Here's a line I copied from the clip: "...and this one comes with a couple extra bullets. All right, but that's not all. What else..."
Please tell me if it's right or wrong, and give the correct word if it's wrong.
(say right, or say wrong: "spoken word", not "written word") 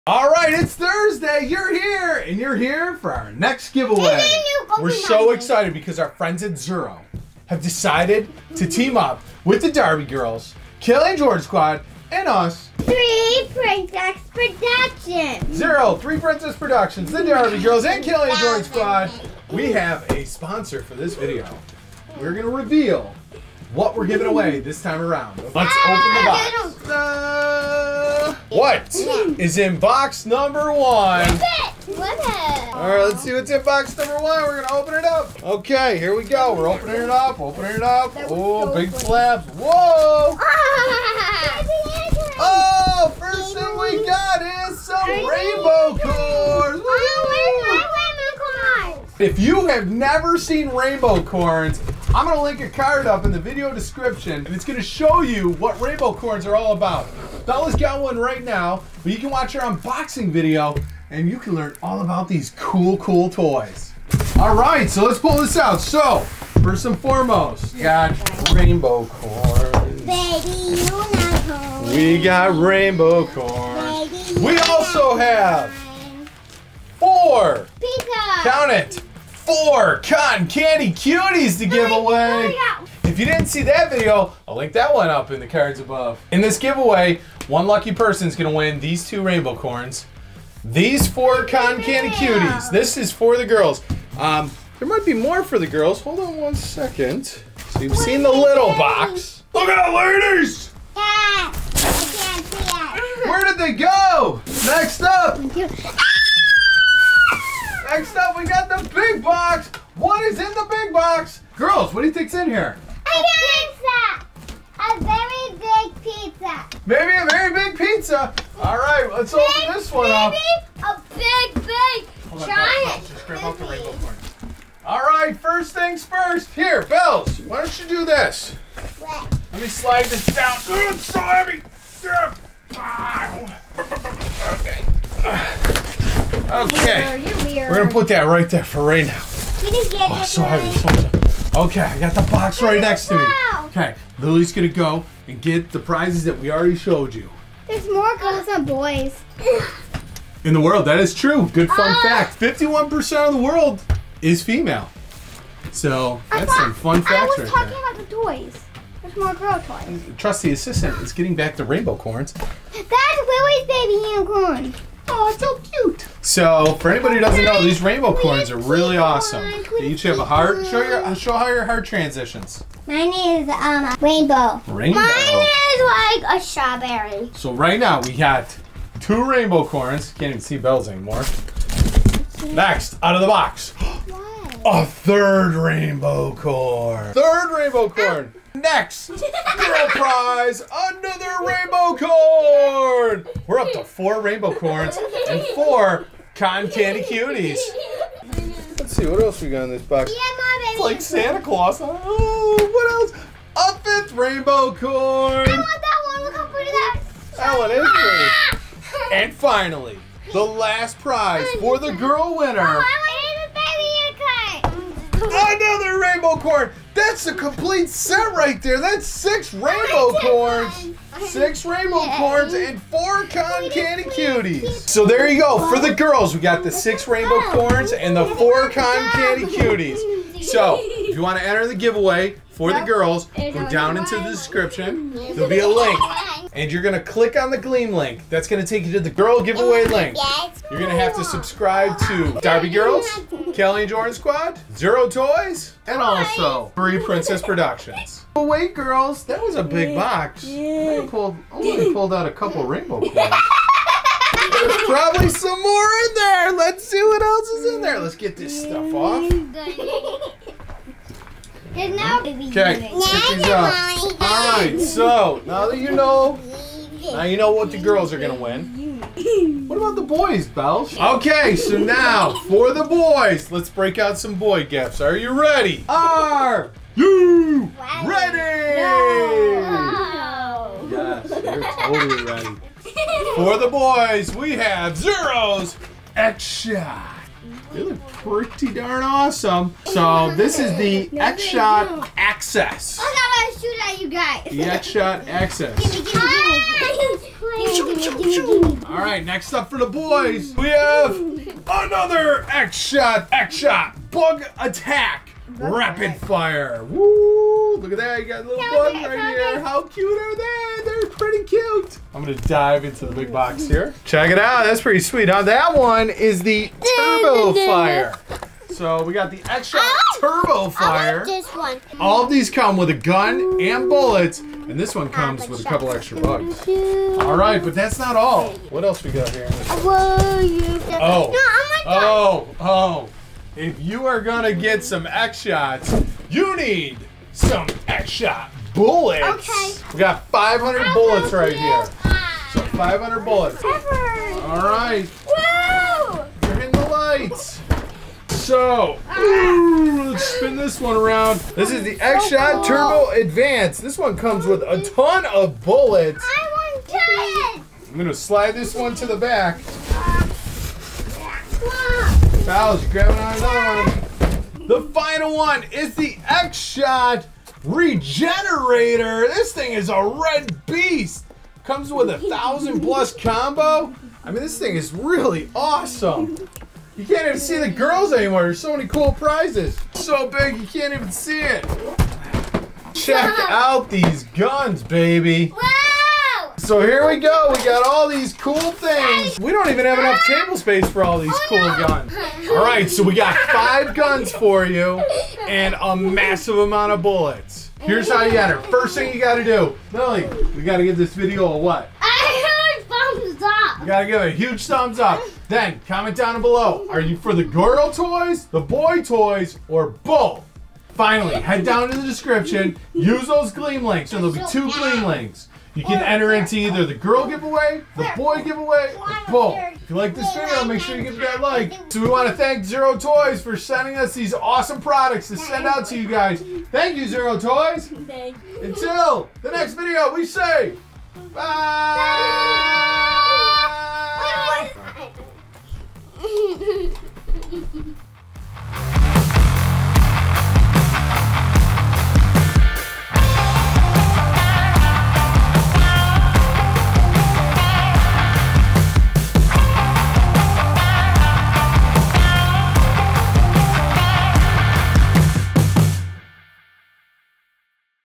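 right.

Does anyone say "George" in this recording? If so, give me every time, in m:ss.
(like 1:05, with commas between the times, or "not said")
0:11, 0:18.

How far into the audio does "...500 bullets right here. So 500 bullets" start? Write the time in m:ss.
5:40.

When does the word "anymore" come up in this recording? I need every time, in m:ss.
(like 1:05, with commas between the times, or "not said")
3:00, 6:18.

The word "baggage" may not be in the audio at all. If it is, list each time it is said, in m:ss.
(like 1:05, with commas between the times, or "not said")
not said.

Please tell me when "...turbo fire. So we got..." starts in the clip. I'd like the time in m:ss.
5:17.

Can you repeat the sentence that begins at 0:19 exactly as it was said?
We have a sponsor for this video.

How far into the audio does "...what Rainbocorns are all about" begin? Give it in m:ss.
0:55.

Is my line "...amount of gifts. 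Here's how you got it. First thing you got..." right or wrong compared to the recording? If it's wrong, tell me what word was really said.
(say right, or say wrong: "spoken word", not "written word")
wrong: "bullets", not "gifts".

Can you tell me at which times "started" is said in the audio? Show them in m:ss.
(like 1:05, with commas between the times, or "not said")
not said.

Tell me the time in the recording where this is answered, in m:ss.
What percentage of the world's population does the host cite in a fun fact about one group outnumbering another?
2:32.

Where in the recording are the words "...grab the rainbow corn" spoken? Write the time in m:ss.
2:03.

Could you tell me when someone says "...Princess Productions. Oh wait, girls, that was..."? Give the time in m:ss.
4:06.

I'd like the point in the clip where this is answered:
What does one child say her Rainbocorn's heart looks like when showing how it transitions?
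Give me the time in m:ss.
2:56.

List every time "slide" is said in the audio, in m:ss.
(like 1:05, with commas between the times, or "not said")
2:09, 5:58.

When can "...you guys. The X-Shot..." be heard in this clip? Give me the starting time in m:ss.
4:54.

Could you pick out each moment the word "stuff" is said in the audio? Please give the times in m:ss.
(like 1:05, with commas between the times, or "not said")
4:18.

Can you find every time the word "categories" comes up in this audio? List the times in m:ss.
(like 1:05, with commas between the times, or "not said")
not said.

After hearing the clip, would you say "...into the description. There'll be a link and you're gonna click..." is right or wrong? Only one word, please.
right.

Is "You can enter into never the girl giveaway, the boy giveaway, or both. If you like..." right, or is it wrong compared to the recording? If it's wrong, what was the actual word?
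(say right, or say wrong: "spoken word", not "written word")
wrong: "either", not "never".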